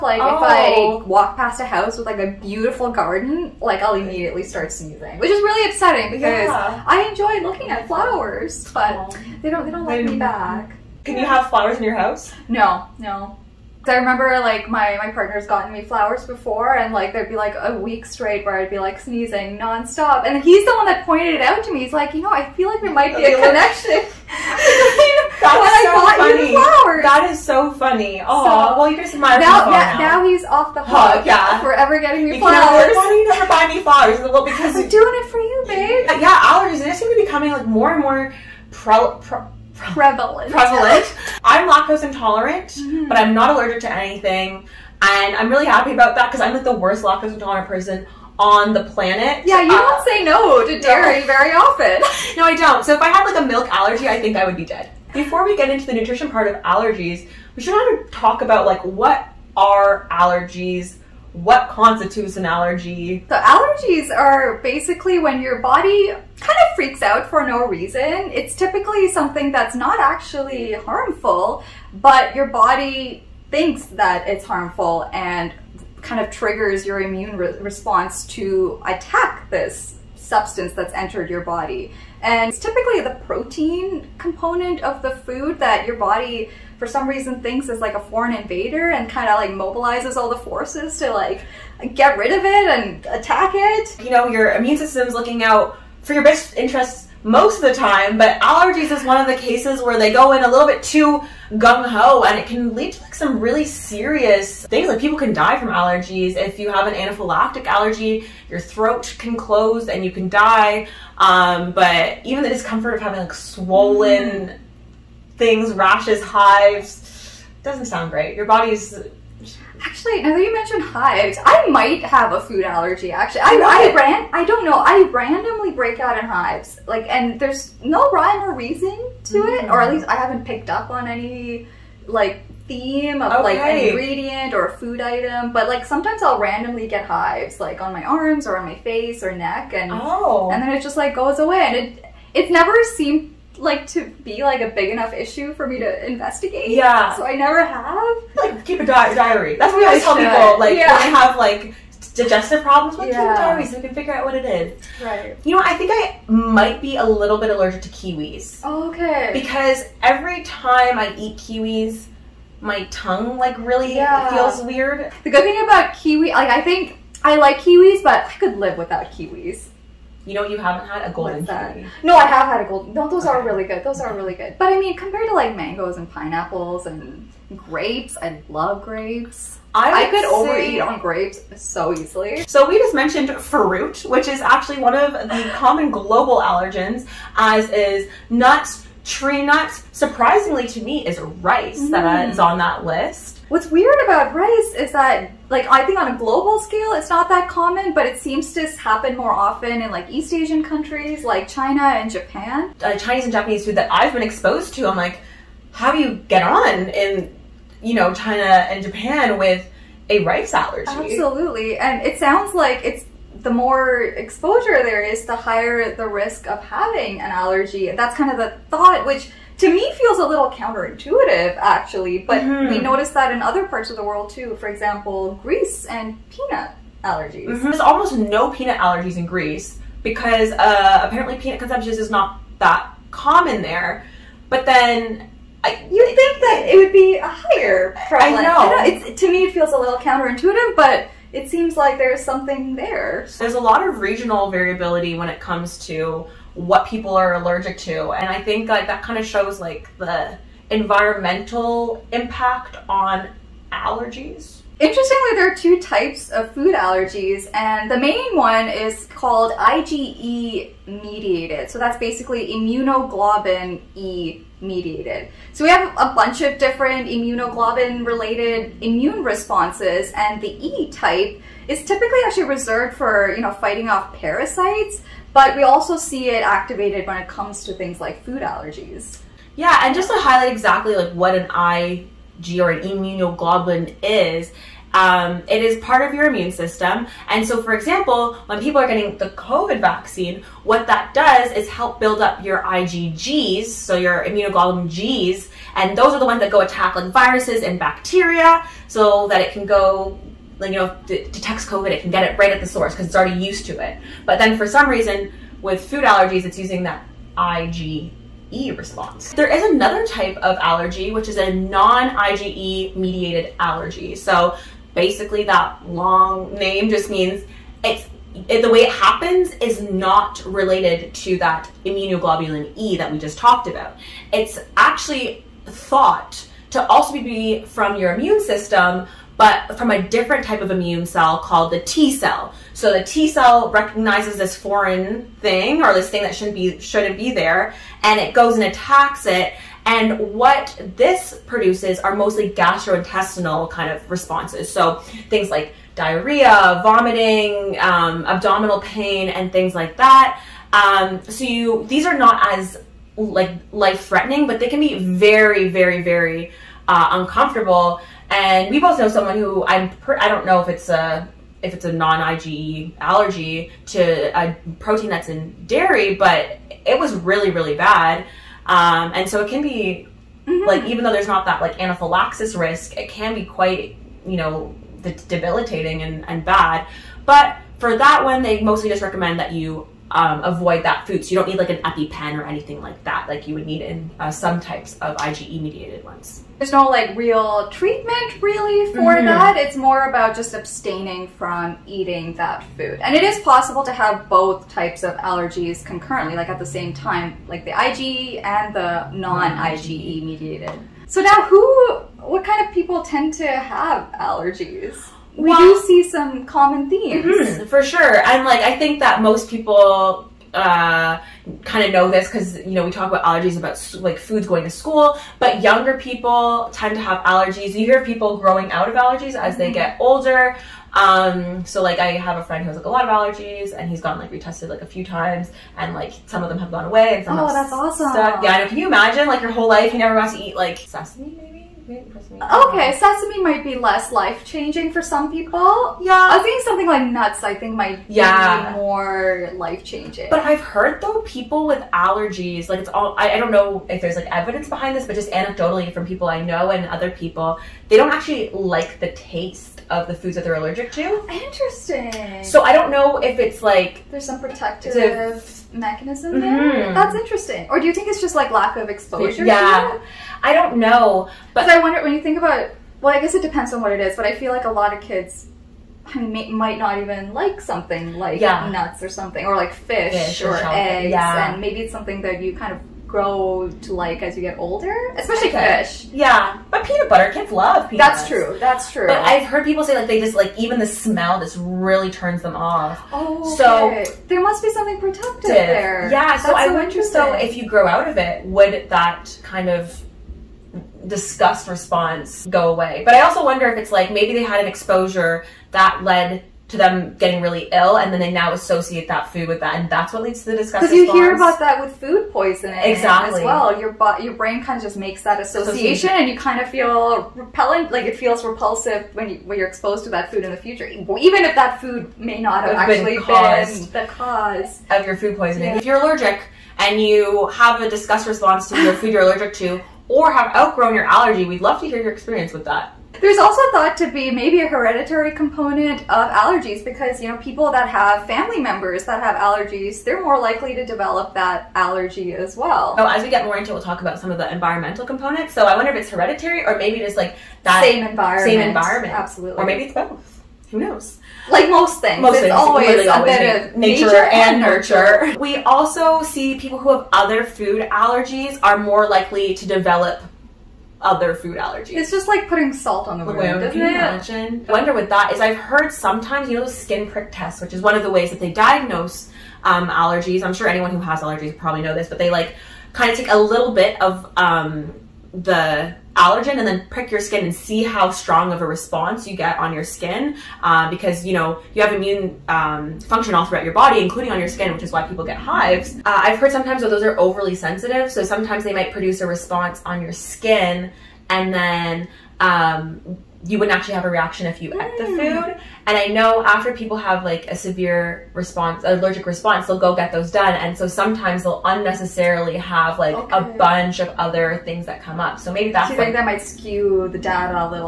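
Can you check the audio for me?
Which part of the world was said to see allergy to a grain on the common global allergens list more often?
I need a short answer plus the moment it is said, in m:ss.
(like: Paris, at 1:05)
East Asian countries, at 3:20.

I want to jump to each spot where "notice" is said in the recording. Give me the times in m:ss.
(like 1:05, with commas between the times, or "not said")
3:42.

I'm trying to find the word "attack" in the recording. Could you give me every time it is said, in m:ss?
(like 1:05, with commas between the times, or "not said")
1:18, 1:33, 4:56, 5:38.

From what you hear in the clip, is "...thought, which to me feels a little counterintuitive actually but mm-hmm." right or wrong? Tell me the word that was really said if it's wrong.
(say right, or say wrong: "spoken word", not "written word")
right.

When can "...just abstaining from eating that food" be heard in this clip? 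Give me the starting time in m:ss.
6:30.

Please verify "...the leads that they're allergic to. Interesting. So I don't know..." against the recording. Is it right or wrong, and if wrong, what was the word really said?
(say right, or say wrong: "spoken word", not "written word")
wrong: "foods", not "leads".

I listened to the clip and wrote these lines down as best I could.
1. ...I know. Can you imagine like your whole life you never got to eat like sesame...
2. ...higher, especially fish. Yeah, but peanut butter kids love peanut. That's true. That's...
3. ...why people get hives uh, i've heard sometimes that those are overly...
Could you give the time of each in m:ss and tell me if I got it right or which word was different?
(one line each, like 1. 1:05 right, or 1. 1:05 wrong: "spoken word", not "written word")
1. 7:08 right
2. 7:54 wrong: "older", not "higher"
3. 9:34 right.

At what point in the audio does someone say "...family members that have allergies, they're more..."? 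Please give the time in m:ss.
8:48.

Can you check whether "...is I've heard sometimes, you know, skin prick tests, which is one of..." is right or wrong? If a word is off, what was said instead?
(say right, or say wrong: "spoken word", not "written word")
right.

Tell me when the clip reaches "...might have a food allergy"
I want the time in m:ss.
2:01.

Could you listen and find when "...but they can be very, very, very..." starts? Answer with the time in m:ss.
5:54.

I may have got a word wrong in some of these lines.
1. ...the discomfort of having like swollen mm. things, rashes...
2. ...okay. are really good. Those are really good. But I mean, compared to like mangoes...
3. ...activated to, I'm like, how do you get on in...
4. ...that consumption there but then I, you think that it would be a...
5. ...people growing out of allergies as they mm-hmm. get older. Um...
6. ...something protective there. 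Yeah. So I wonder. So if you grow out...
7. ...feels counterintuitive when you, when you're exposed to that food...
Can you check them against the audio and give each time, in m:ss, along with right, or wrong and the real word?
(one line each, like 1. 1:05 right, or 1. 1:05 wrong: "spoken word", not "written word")
1. 1:52 right
2. 2:53 right
3. 3:24 wrong: "exposed", not "activated"
4. 3:52 wrong: "common", not "consumption"
5. 6:58 right
6. 8:04 right
7. 8:28 wrong: "repulsive", not "counterintuitive".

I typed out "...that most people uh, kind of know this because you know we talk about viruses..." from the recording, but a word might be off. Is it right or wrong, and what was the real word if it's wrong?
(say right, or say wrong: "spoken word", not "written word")
wrong: "allergies", not "viruses".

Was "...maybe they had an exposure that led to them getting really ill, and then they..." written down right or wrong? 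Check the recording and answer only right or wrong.
right.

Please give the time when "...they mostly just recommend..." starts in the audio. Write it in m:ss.
6:18.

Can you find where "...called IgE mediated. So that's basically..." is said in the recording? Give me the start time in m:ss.
4:19.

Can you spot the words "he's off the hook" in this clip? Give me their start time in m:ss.
0:30.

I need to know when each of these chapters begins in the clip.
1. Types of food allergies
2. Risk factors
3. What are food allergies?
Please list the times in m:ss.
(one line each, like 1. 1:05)
1. 4:14
2. 6:41
3. 0:54.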